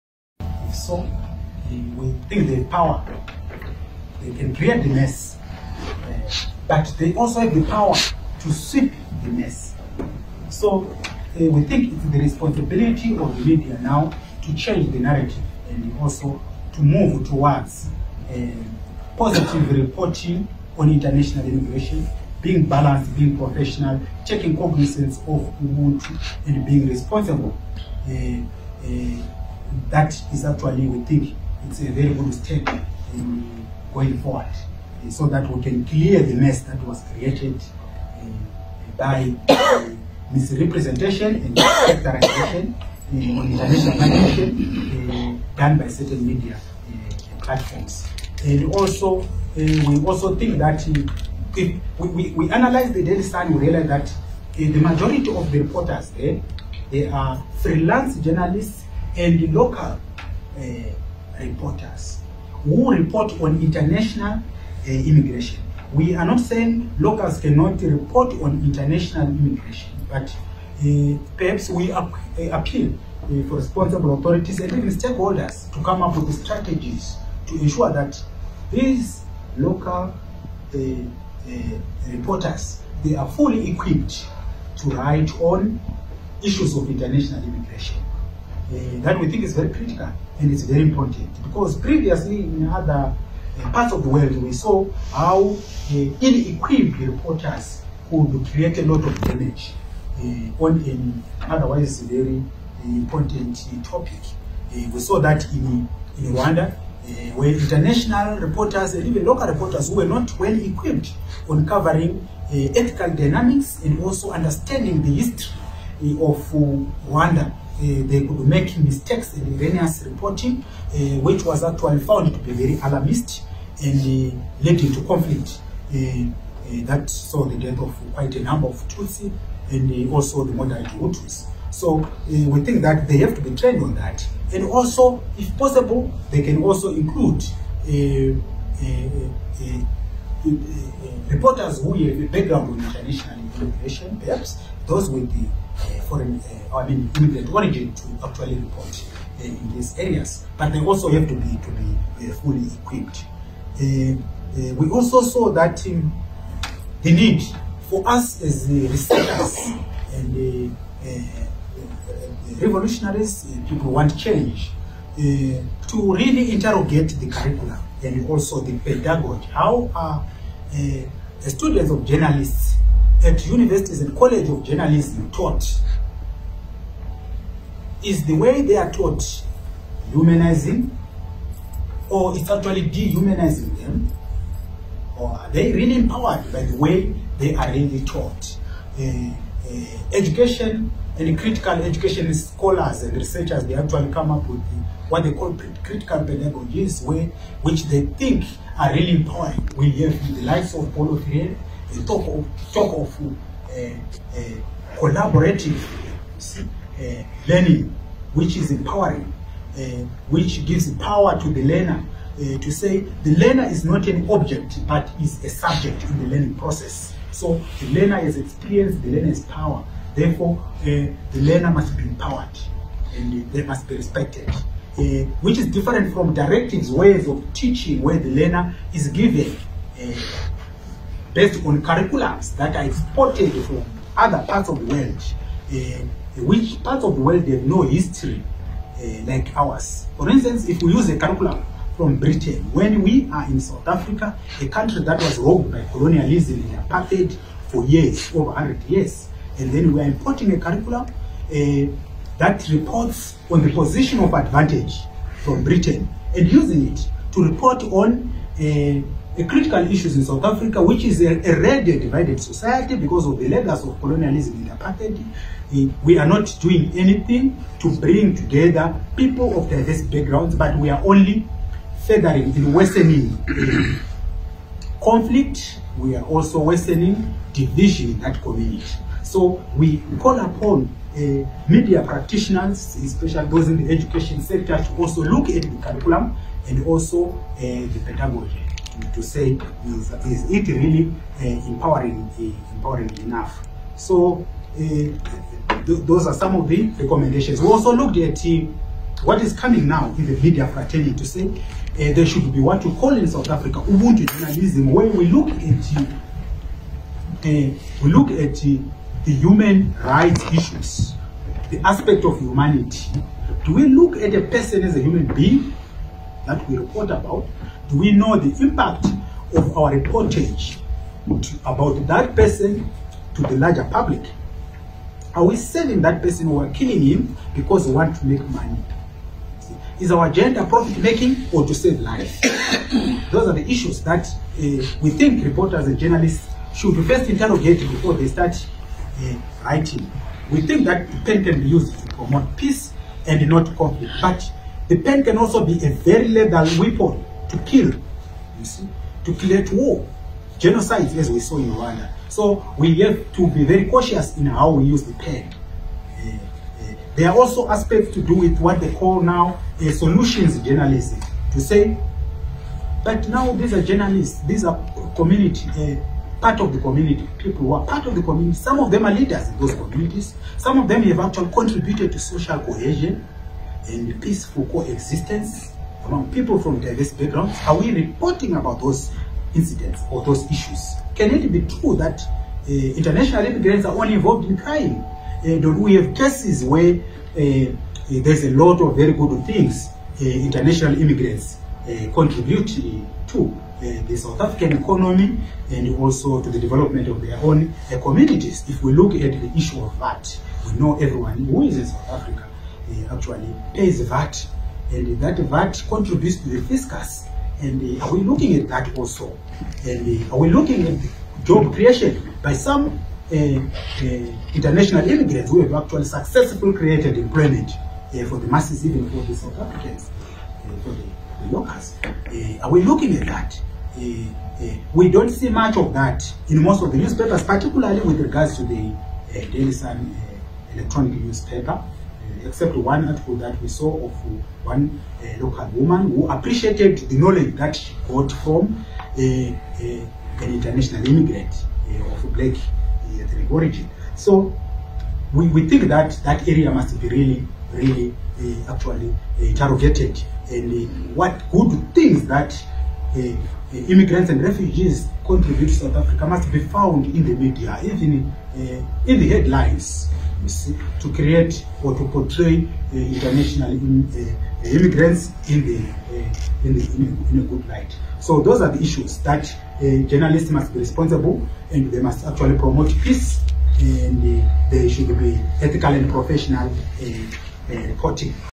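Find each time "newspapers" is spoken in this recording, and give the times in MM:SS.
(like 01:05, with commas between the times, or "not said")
07:06, 07:11.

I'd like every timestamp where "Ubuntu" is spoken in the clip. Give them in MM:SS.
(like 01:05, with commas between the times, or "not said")
00:25, 05:03.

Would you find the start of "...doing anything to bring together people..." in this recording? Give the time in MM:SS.
04:26.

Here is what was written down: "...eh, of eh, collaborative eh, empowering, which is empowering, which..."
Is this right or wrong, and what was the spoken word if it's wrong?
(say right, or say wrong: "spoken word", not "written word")
wrong: "learning", not "empowering".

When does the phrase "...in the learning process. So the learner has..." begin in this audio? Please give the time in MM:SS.
03:36.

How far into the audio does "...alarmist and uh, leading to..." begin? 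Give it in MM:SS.
02:02.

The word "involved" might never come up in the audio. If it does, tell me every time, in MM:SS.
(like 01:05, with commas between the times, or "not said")
06:24.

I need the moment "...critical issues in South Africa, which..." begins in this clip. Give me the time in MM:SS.
04:19.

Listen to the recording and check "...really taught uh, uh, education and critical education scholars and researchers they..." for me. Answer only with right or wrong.
right.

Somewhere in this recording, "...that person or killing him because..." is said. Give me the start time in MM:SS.
05:26.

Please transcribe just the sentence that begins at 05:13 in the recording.
Do we look at a person as a human being that we report about?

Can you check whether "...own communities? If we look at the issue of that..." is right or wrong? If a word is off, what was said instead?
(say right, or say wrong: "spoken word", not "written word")
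right.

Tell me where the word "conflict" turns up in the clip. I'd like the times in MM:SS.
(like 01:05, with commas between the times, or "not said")
02:05, 04:35, 05:43.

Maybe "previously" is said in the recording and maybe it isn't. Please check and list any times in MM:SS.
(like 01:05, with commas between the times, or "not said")
01:31.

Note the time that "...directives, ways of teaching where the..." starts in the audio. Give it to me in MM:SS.
03:46.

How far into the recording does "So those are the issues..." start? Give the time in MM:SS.
07:48.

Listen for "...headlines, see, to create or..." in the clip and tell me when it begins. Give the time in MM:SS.
07:39.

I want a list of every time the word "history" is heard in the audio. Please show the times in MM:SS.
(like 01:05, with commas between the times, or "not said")
01:55, 03:57.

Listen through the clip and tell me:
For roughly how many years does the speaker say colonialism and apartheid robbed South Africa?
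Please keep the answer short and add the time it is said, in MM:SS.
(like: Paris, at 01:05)
over 100 years, at 04:08.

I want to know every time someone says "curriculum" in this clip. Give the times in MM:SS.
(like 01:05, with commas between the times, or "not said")
02:47, 03:51, 04:01, 04:10, 04:45.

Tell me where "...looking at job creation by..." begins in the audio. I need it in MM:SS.
06:50.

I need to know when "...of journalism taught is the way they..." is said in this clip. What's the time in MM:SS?
02:54.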